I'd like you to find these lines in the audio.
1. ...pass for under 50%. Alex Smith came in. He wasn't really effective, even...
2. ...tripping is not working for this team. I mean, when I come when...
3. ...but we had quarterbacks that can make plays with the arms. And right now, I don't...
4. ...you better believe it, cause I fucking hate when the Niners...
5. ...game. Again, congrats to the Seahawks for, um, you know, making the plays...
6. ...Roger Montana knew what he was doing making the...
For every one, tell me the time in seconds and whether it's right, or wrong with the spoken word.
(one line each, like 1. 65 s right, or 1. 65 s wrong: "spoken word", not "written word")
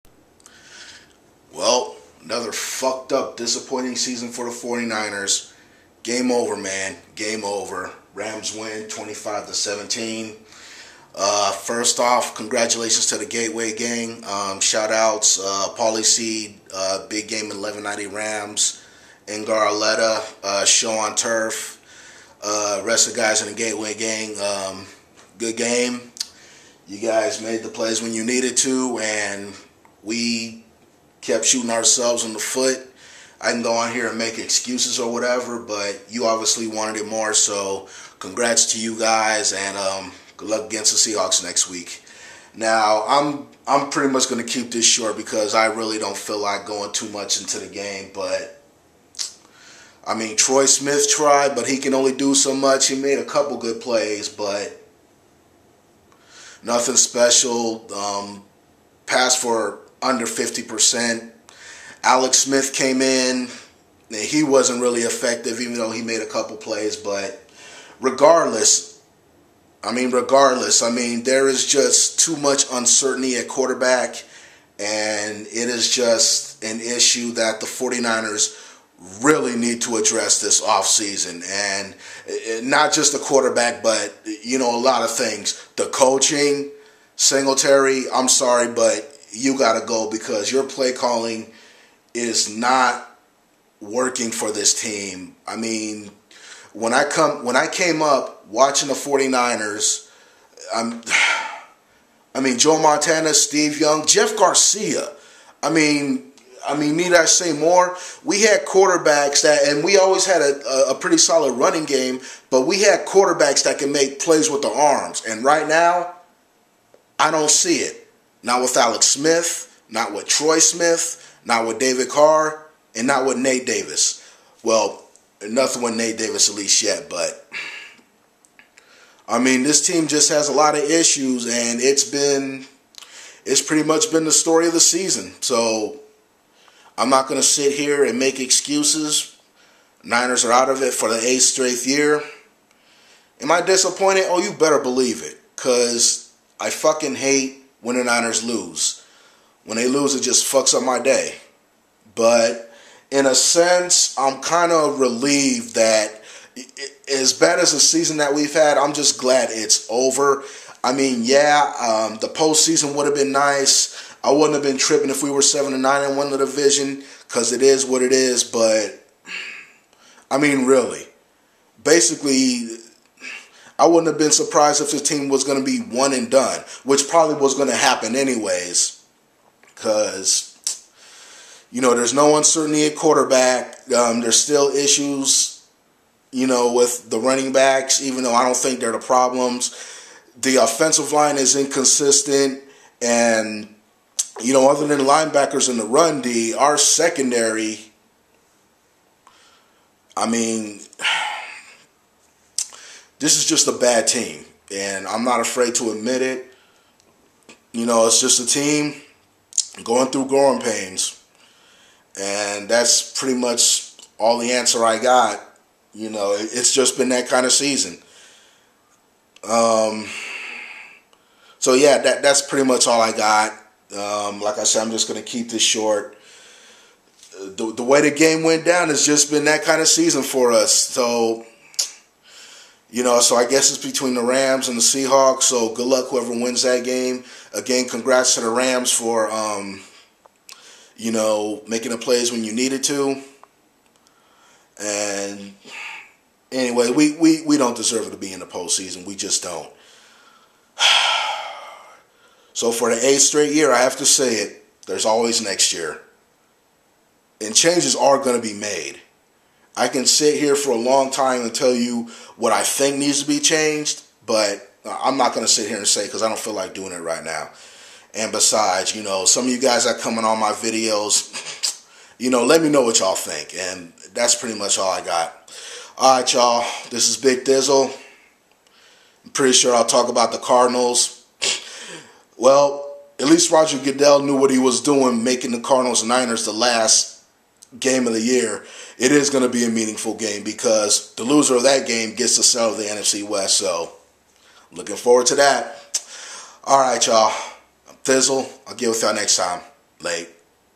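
1. 59 s right
2. 90 s wrong: "calling", not "tripping"
3. 112 s right
4. 144 s right
5. 236 s wrong: "Rams", not "Seahawks"
6. 283 s wrong: "Goodell", not "Montana".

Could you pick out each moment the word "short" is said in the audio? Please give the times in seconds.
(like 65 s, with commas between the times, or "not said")
44 s, 225 s.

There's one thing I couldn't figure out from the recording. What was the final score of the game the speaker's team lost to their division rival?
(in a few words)
25 to 17.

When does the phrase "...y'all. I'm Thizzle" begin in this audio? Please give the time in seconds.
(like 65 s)
297 s.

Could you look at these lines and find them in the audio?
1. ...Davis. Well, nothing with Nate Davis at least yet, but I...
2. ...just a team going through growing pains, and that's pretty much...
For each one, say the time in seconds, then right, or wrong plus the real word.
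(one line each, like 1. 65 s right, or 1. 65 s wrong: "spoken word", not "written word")
1. 123 s right
2. 208 s right.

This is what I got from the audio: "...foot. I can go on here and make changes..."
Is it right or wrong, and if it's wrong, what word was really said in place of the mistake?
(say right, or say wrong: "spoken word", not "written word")
wrong: "excuses", not "changes".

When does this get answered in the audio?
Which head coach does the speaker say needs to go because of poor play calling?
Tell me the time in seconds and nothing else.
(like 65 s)
87 s.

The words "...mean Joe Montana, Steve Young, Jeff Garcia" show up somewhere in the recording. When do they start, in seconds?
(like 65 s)
102 s.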